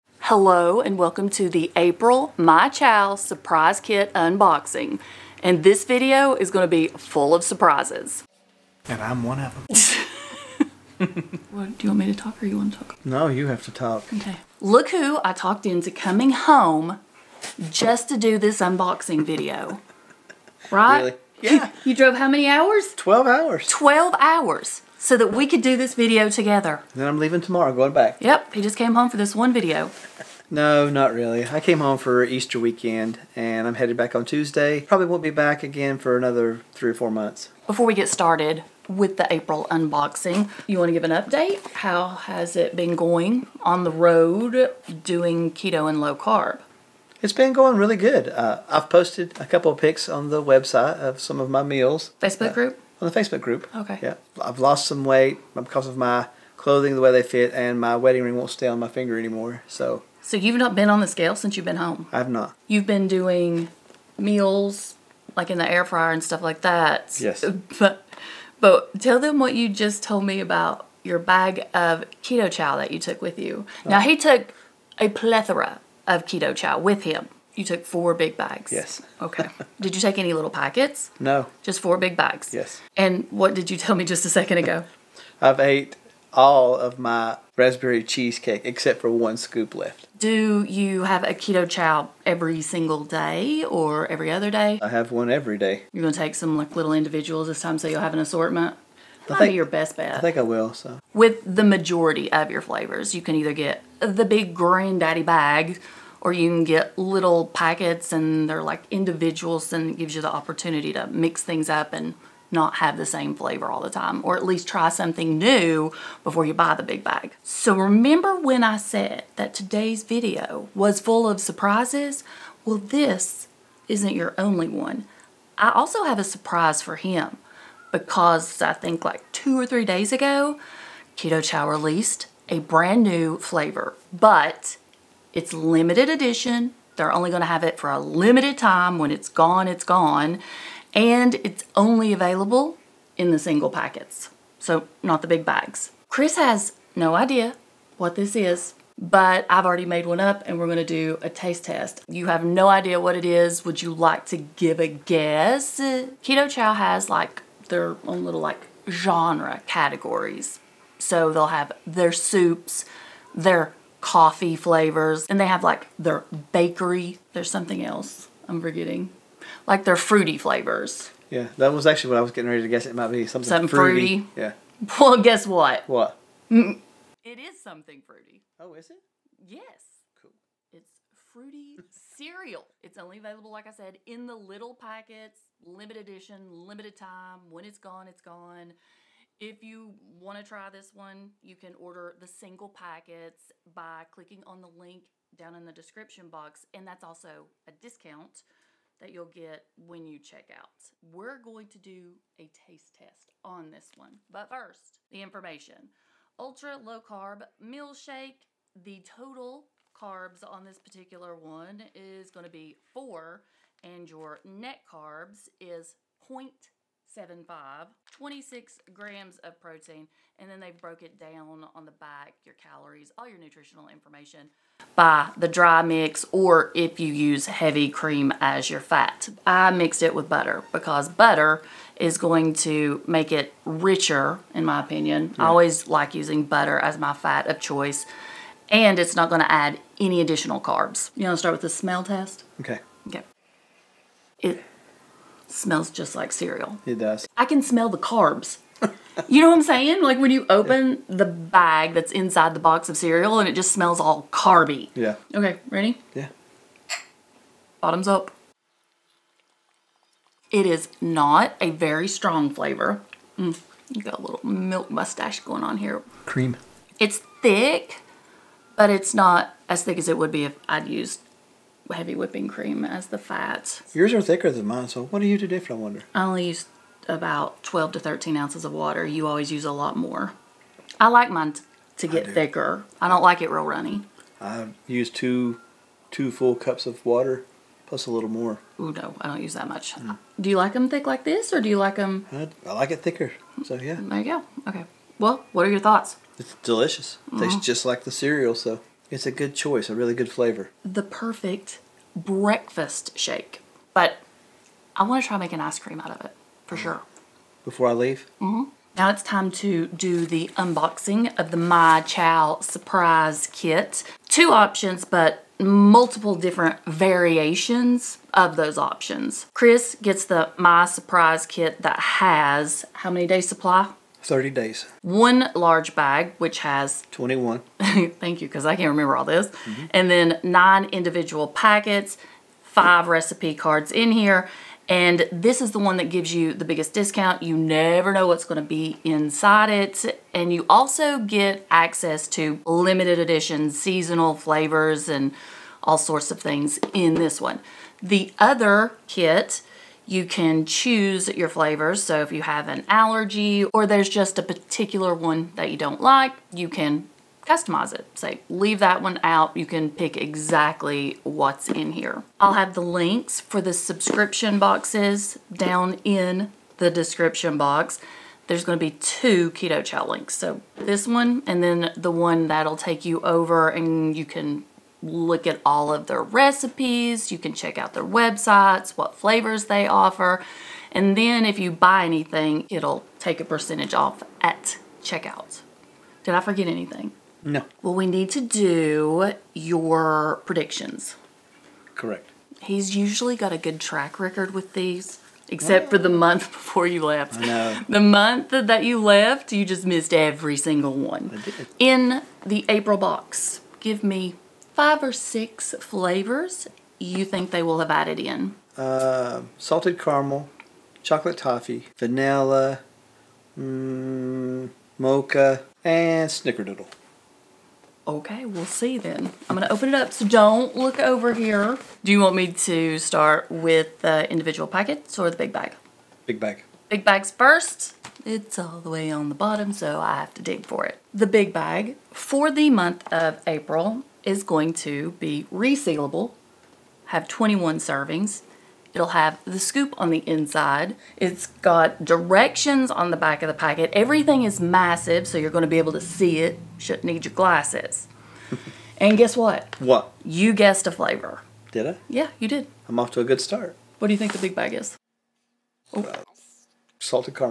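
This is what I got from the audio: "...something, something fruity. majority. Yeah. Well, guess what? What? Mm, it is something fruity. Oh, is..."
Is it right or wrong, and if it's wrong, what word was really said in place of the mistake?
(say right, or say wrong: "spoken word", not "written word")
wrong: "fruity", not "majority".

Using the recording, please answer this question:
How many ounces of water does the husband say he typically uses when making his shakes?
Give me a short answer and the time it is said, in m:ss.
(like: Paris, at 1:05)
12 to 13, at 4:37.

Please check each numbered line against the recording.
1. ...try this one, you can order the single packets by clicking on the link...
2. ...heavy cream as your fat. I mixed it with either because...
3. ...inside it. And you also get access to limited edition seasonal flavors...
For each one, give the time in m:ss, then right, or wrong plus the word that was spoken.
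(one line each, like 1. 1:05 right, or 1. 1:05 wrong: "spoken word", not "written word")
1. 3:10 right
2. 3:47 wrong: "butter", not "either"
3. 5:39 right.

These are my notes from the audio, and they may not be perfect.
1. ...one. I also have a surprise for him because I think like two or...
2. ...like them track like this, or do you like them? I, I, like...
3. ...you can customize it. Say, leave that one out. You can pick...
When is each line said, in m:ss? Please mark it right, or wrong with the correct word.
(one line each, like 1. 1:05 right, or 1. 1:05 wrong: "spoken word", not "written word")
1. 2:04 right
2. 4:50 wrong: "thick", not "track"
3. 5:56 right.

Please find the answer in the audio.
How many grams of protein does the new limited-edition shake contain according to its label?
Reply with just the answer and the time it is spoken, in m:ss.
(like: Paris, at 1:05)
26, at 3:38.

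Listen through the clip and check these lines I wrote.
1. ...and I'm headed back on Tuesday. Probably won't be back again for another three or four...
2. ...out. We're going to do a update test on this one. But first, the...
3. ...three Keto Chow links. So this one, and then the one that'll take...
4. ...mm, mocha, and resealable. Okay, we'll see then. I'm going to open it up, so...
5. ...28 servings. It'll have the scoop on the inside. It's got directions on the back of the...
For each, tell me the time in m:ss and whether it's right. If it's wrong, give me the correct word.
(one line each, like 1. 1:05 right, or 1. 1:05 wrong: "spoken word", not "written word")
1. 0:33 right
2. 3:20 wrong: "taste", not "update"
3. 6:08 wrong: "two", not "three"
4. 6:53 wrong: "snickerdoodle", not "resealable"
5. 7:17 wrong: "21", not "28".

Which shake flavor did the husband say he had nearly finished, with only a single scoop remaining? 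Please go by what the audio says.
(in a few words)
raspberry cheesecake.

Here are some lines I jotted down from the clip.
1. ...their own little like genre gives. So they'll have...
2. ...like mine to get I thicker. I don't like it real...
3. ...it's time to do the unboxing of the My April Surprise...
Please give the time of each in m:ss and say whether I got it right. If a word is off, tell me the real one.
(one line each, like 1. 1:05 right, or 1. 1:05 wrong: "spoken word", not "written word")
1. 2:37 wrong: "categories", not "gives"
2. 4:41 right
3. 5:09 wrong: "Chow", not "April".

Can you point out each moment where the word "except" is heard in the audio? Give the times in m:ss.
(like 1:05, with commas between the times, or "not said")
1:28, 6:35.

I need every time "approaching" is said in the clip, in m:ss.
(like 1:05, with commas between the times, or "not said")
not said.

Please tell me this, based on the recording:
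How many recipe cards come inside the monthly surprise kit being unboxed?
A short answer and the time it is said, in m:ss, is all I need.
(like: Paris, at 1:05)
5, at 5:32.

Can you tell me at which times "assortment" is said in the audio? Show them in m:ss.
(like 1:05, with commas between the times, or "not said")
1:38.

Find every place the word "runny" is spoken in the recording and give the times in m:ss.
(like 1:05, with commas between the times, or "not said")
4:43.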